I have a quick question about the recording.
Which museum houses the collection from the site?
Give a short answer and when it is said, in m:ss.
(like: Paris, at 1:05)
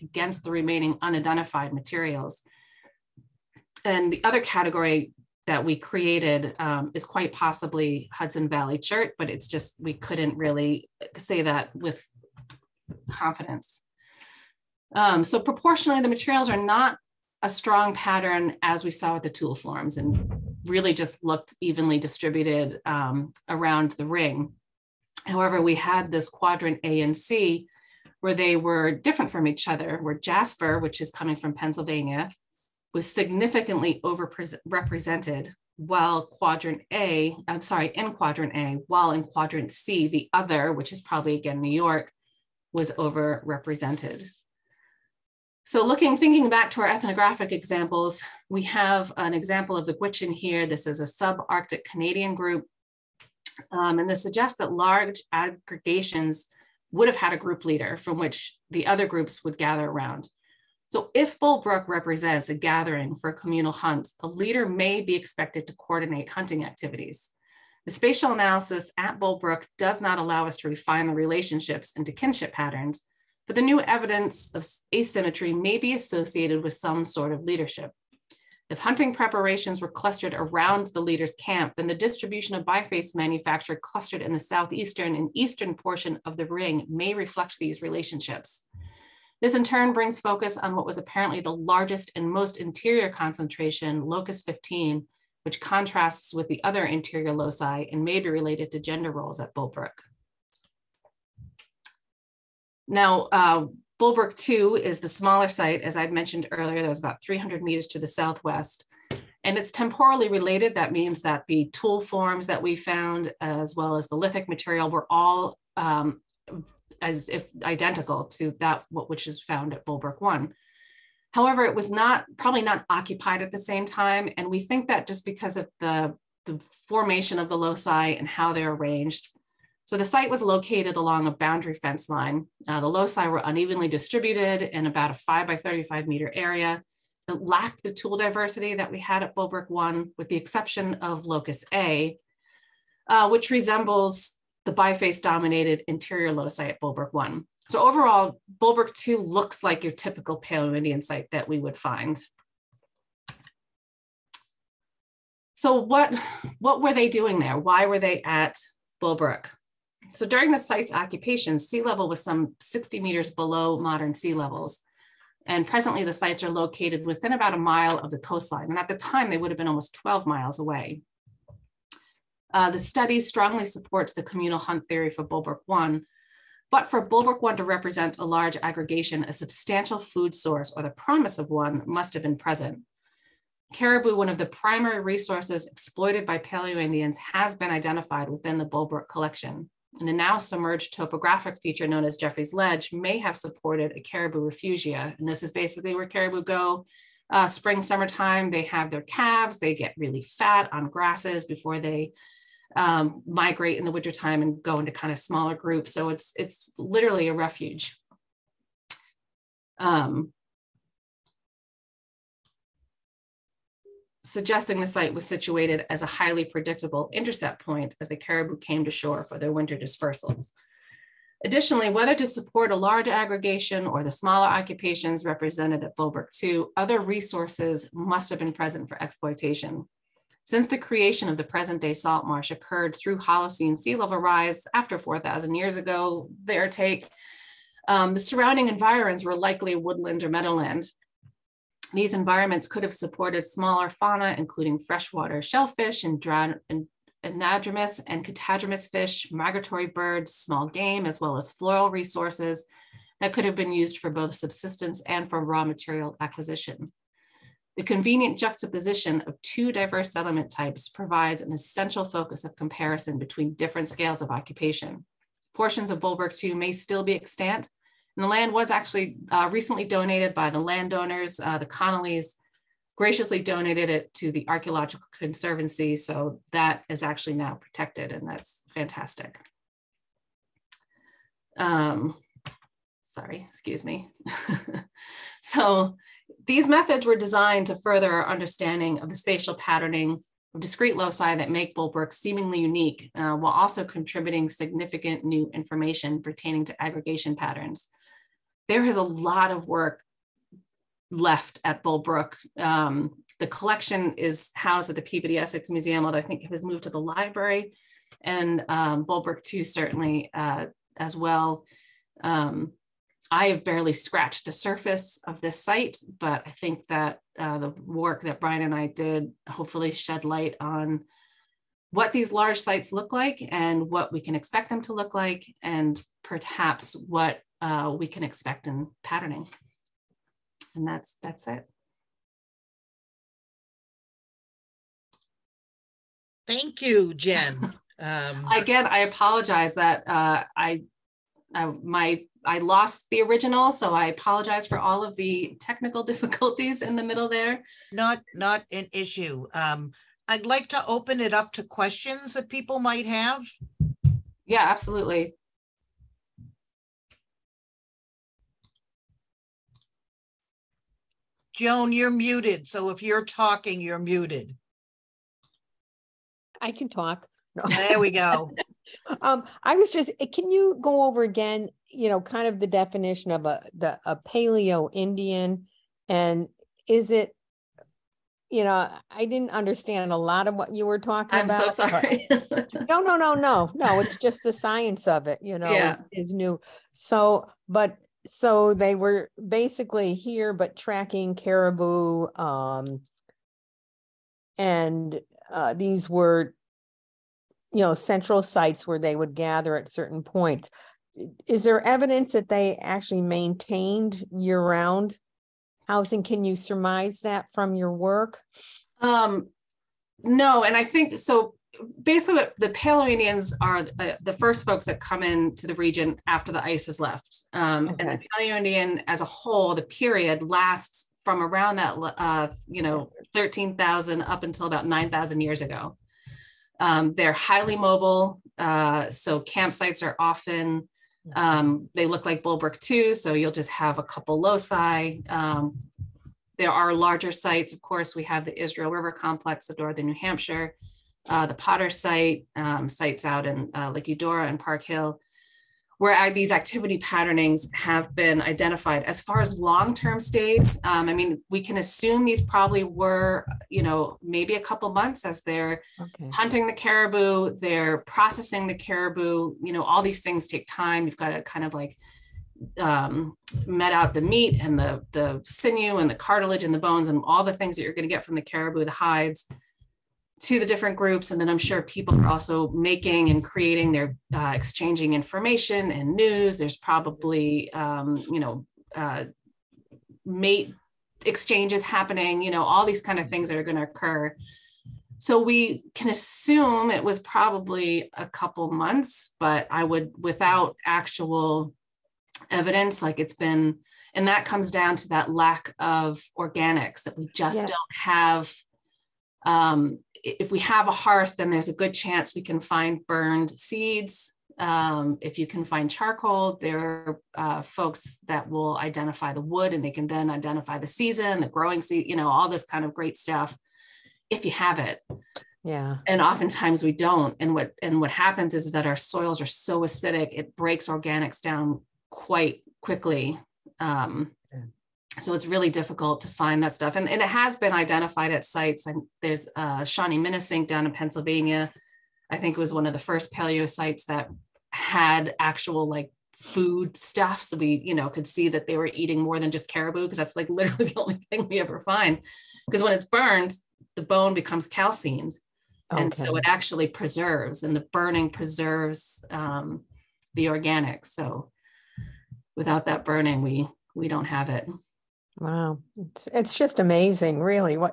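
Peabody Essex Museum, at 5:05.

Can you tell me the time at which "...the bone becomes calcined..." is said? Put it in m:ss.
9:03.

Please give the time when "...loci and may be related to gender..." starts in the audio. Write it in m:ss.
1:37.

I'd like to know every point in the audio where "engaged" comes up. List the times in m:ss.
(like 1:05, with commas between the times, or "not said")
not said.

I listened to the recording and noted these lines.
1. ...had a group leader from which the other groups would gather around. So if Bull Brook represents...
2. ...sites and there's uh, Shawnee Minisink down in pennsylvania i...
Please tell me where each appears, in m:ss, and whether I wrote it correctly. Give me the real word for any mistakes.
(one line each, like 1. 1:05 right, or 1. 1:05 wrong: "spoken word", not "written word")
1. 0:57 right
2. 8:48 right.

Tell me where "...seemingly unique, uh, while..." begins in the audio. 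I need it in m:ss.
4:52.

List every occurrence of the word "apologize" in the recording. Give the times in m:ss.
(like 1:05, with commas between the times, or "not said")
5:38, 5:44.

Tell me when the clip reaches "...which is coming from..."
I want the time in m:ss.
0:30.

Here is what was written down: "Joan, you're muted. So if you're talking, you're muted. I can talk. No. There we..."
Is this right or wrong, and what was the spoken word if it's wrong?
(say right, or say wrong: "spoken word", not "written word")
right.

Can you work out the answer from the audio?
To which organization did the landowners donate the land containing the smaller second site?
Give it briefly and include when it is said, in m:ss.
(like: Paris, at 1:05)
Archaeological Conservancy, at 4:34.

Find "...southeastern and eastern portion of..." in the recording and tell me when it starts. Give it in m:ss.
1:24.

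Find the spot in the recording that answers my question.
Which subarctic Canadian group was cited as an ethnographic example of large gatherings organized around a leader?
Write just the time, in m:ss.
0:49.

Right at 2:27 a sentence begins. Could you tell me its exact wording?
So overall, Bull Brook 2 looks like your typical Paleo Indian site that we would find.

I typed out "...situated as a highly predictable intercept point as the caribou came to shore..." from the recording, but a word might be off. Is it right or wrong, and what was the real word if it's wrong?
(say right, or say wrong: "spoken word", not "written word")
right.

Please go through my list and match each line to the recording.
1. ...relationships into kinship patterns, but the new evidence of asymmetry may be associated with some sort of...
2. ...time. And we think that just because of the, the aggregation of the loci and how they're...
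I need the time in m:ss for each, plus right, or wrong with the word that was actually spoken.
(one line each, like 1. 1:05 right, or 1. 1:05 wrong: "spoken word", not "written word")
1. 1:11 right
2. 2:03 wrong: "formation", not "aggregation".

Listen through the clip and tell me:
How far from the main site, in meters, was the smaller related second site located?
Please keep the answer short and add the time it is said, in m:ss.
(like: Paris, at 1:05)
300 meters, at 1:47.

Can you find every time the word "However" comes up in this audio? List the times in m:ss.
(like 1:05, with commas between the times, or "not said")
0:25, 2:01.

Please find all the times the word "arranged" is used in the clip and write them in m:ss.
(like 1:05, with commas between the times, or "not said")
2:08.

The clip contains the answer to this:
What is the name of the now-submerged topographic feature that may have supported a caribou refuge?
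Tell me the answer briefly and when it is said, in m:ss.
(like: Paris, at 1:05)
Jeffrey's Ledge, at 3:12.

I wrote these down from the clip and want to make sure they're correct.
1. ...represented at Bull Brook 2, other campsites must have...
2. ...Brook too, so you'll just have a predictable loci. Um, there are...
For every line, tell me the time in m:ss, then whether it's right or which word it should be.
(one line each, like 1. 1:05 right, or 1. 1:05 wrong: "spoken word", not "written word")
1. 3:45 wrong: "resources", not "campsites"
2. 7:12 wrong: "couple", not "predictable".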